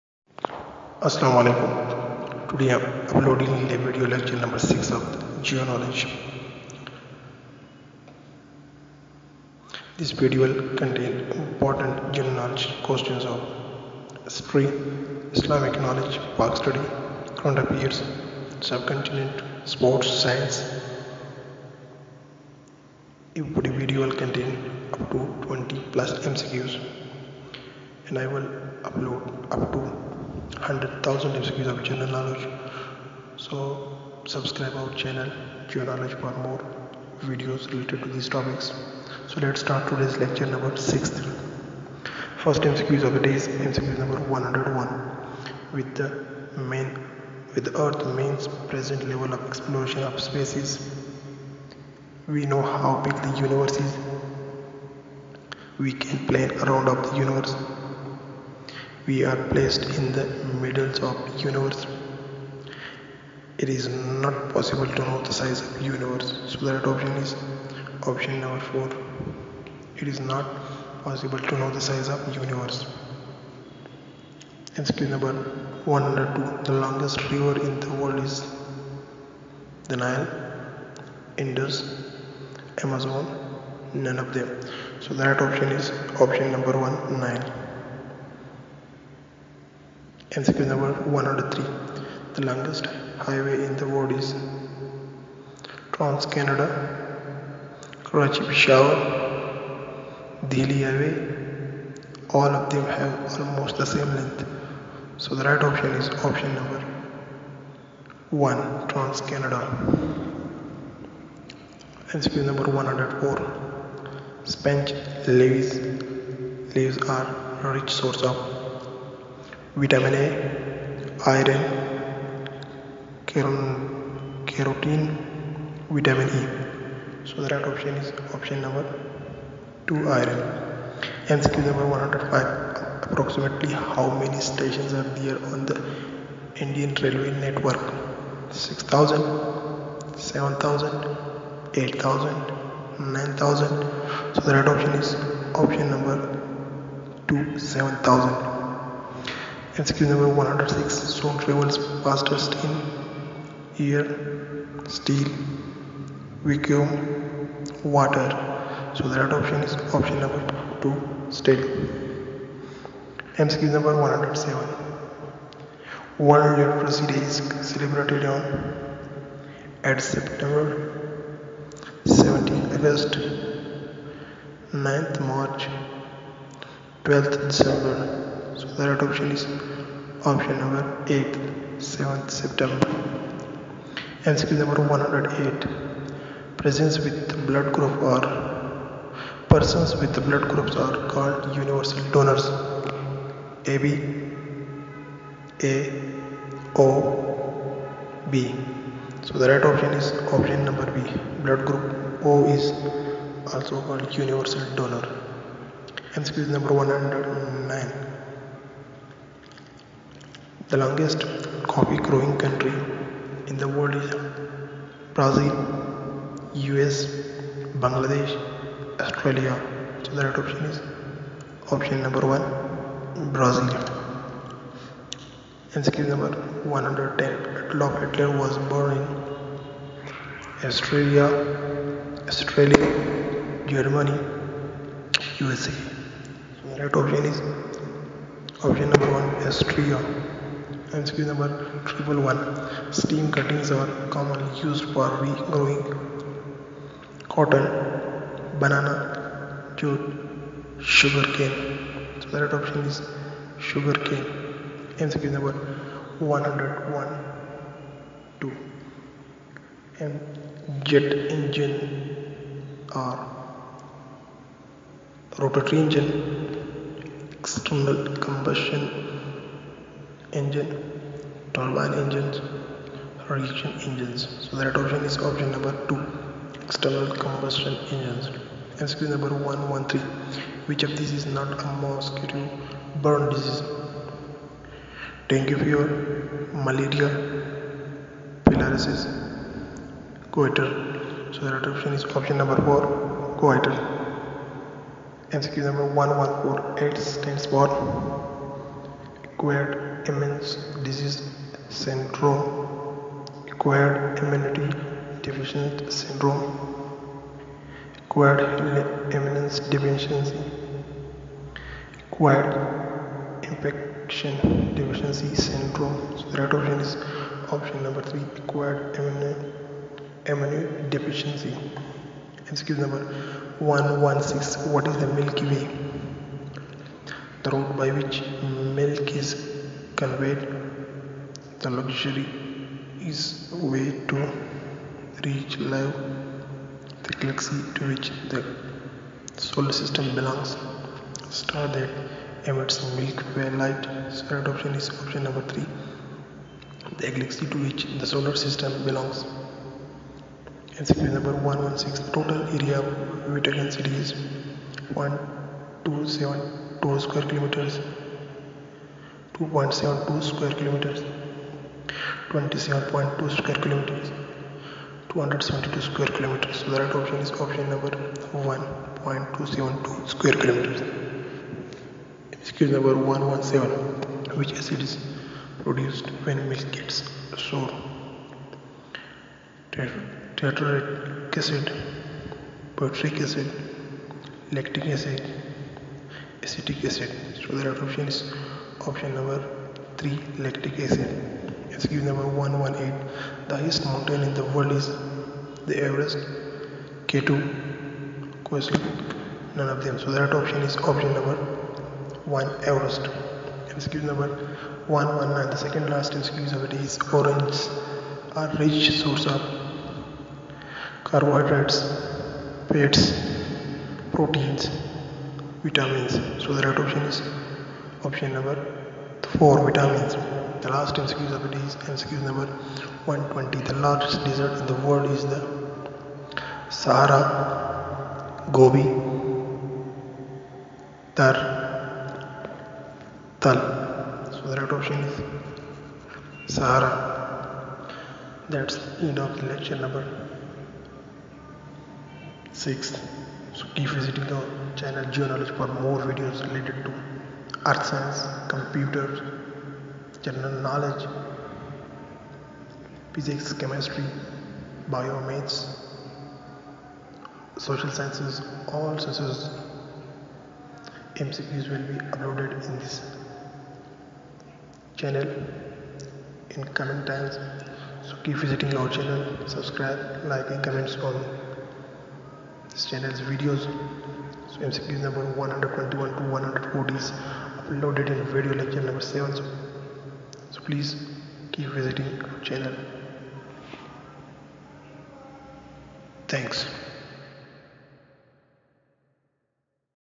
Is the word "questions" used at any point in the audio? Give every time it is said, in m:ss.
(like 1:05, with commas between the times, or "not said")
0:12, 6:38.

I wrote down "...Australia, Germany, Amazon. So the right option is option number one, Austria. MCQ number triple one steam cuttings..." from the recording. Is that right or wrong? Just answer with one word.
wrong.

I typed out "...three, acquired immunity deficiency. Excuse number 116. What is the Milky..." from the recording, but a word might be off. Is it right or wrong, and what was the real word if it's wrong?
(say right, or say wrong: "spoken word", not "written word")
right.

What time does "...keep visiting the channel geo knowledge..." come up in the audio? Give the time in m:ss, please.
7:23.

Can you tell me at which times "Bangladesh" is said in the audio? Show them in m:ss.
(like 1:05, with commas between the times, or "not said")
3:37.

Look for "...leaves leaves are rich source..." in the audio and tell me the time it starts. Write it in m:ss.
1:55.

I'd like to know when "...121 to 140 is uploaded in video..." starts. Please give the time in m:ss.
7:55.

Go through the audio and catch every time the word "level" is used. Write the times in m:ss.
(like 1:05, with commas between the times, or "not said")
0:49.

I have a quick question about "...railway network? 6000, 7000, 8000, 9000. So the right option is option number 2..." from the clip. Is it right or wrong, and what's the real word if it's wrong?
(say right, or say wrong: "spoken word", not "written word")
right.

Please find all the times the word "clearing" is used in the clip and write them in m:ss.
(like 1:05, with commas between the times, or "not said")
not said.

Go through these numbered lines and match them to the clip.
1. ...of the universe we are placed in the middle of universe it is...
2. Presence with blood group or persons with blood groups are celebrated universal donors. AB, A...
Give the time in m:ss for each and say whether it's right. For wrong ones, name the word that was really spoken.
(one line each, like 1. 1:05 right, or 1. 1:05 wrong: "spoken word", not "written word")
1. 0:56 right
2. 3:06 wrong: "called", not "celebrated".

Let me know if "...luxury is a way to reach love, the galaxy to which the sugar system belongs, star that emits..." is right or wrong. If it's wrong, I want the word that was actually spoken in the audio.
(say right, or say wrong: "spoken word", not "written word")
wrong: "solar", not "sugar".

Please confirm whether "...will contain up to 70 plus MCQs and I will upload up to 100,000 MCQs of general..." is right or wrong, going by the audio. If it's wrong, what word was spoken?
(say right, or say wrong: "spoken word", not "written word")
wrong: "20", not "70".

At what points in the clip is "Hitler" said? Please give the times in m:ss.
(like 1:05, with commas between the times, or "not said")
3:48.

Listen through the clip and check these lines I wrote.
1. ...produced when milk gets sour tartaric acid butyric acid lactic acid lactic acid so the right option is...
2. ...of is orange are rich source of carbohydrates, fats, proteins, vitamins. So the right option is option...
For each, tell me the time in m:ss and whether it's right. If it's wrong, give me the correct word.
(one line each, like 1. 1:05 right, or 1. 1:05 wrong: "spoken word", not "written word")
1. 6:15 wrong: "acetic", not "lactic"
2. 6:46 right.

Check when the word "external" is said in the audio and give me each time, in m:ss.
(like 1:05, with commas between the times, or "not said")
4:27, 4:36.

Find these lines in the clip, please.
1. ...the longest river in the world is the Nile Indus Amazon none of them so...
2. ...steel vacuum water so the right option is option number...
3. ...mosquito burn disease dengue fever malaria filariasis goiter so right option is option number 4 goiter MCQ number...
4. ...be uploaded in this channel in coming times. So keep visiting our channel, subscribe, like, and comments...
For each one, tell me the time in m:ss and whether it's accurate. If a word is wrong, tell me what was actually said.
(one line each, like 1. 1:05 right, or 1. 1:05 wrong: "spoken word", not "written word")
1. 1:16 right
2. 2:34 right
3. 4:41 right
4. 7:41 right.